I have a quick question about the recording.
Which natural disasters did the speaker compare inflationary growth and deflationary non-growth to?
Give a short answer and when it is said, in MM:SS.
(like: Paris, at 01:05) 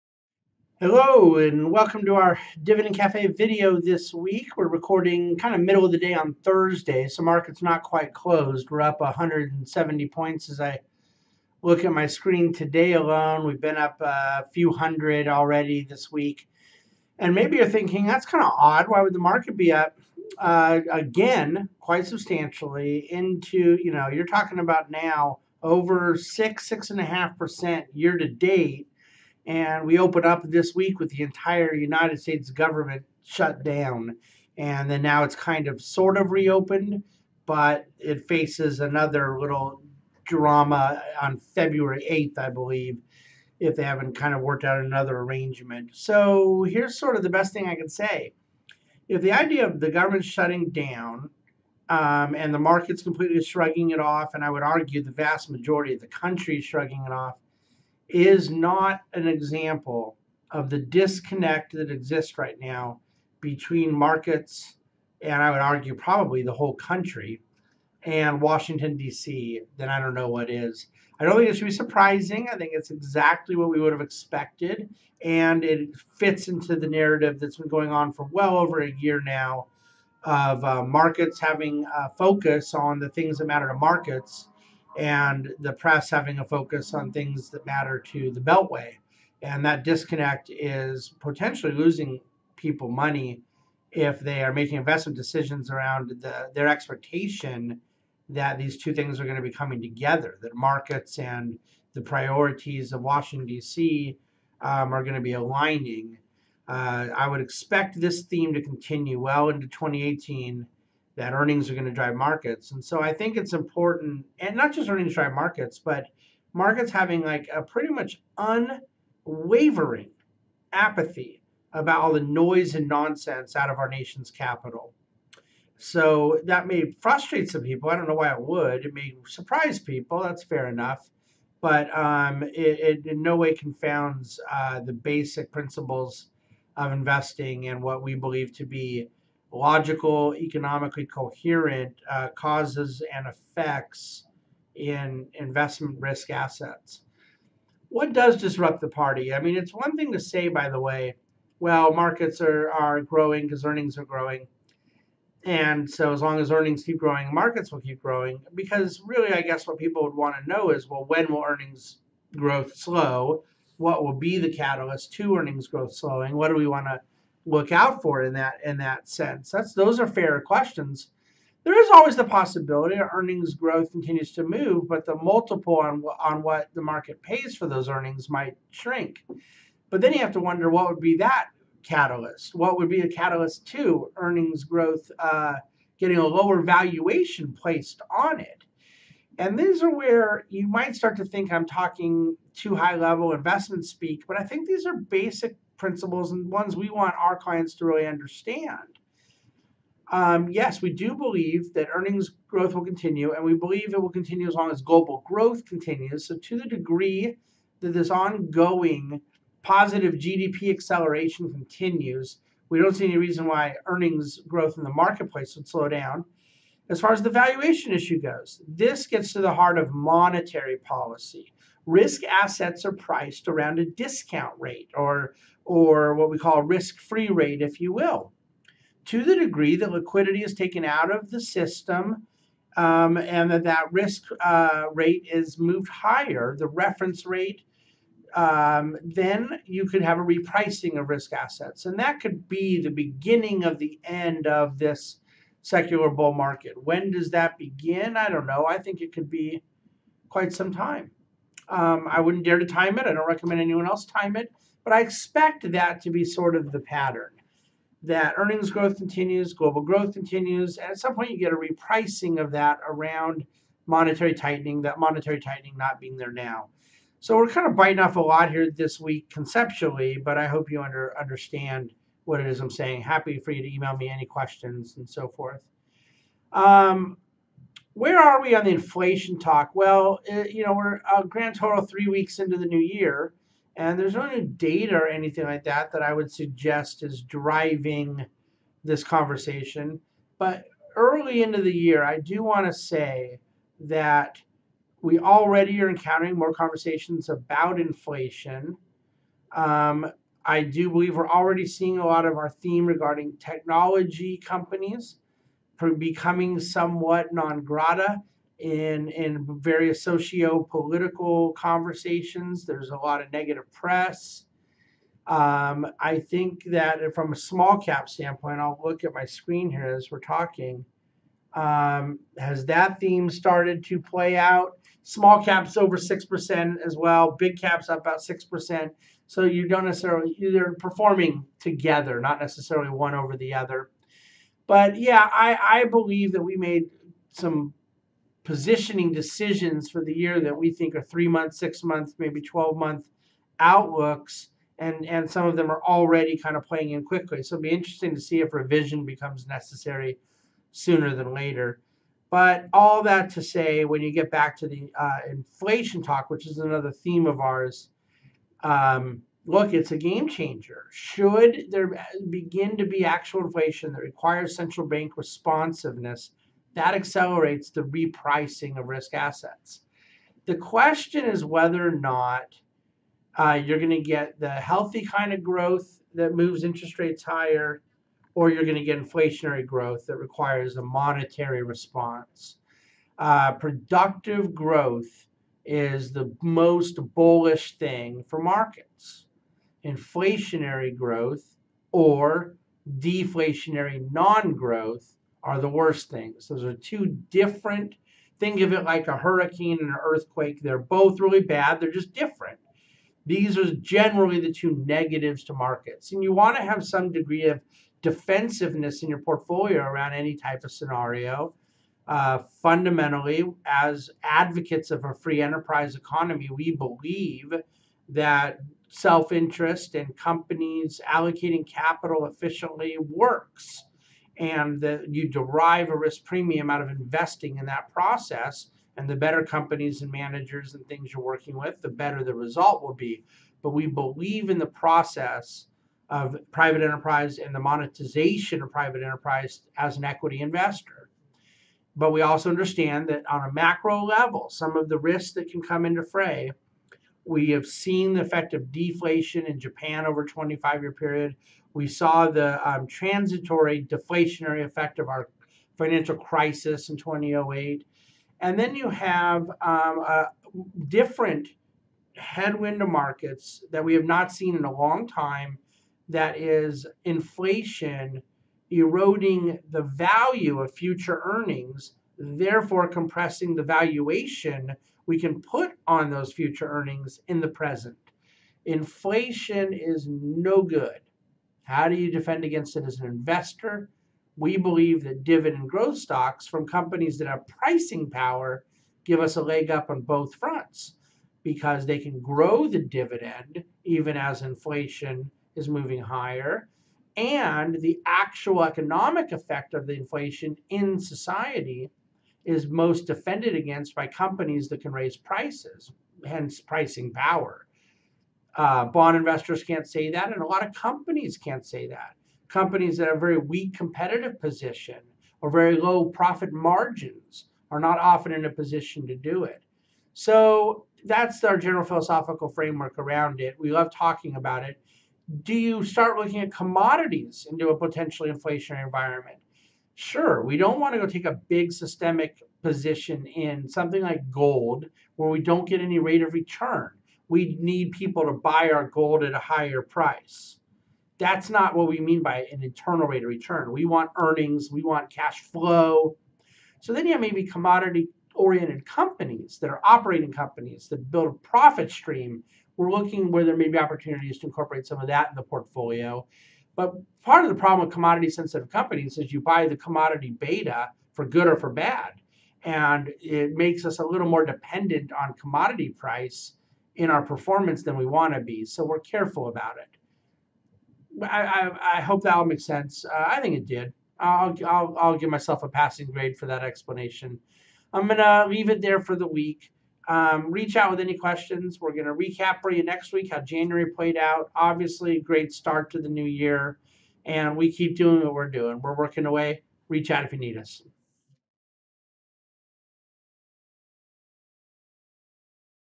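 a hurricane and an earthquake, at 06:39.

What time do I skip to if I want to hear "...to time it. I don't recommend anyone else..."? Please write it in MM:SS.
04:12.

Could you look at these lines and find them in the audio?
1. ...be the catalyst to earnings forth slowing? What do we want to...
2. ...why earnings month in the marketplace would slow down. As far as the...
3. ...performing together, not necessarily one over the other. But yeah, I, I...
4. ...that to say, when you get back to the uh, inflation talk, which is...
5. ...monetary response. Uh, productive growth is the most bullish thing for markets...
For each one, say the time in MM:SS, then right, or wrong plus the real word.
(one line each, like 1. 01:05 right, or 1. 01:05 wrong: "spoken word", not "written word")
1. 02:44 wrong: "growth", not "forth"
2. 03:33 wrong: "growth", not "month"
3. 05:30 right
4. 05:53 right
5. 06:20 right.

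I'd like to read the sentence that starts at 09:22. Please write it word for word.
And it makes us a little more dependent on commodity price in our performance than we want to be.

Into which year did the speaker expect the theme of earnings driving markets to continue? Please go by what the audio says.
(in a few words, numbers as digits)
2018.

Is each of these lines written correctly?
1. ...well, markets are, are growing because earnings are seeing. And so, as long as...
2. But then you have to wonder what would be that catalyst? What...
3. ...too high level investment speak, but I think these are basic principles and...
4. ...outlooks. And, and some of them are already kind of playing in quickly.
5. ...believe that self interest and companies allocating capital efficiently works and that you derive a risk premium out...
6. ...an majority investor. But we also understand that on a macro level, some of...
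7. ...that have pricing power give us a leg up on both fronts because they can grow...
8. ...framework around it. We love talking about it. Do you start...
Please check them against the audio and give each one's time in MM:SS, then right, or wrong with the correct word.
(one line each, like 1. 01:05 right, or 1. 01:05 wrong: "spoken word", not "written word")
1. 02:31 wrong: "growing", not "seeing"
2. 02:59 right
3. 03:12 right
4. 05:43 right
5. 06:56 right
6. 07:19 wrong: "equity", not "majority"
7. 08:07 right
8. 08:42 right.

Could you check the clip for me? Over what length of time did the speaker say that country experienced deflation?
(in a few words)
25 years.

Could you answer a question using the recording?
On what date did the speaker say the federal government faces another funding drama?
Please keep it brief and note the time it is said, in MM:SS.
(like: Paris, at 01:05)
February 8th, at 00:41.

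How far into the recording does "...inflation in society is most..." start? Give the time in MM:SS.
08:19.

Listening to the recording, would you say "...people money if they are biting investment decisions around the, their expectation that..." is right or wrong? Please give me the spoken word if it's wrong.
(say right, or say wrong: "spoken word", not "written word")
wrong: "making", not "biting".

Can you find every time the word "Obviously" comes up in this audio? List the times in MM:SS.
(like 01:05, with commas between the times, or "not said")
09:44.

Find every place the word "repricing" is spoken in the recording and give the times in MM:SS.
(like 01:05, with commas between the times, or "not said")
04:00, 04:21, 06:07.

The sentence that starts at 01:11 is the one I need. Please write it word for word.
I don't think it should be surprising.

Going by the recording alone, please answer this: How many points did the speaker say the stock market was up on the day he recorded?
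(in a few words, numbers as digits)
170.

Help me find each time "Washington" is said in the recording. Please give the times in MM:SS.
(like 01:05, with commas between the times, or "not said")
01:08, 01:43.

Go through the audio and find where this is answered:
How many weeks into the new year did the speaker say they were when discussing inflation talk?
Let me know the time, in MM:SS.
04:41.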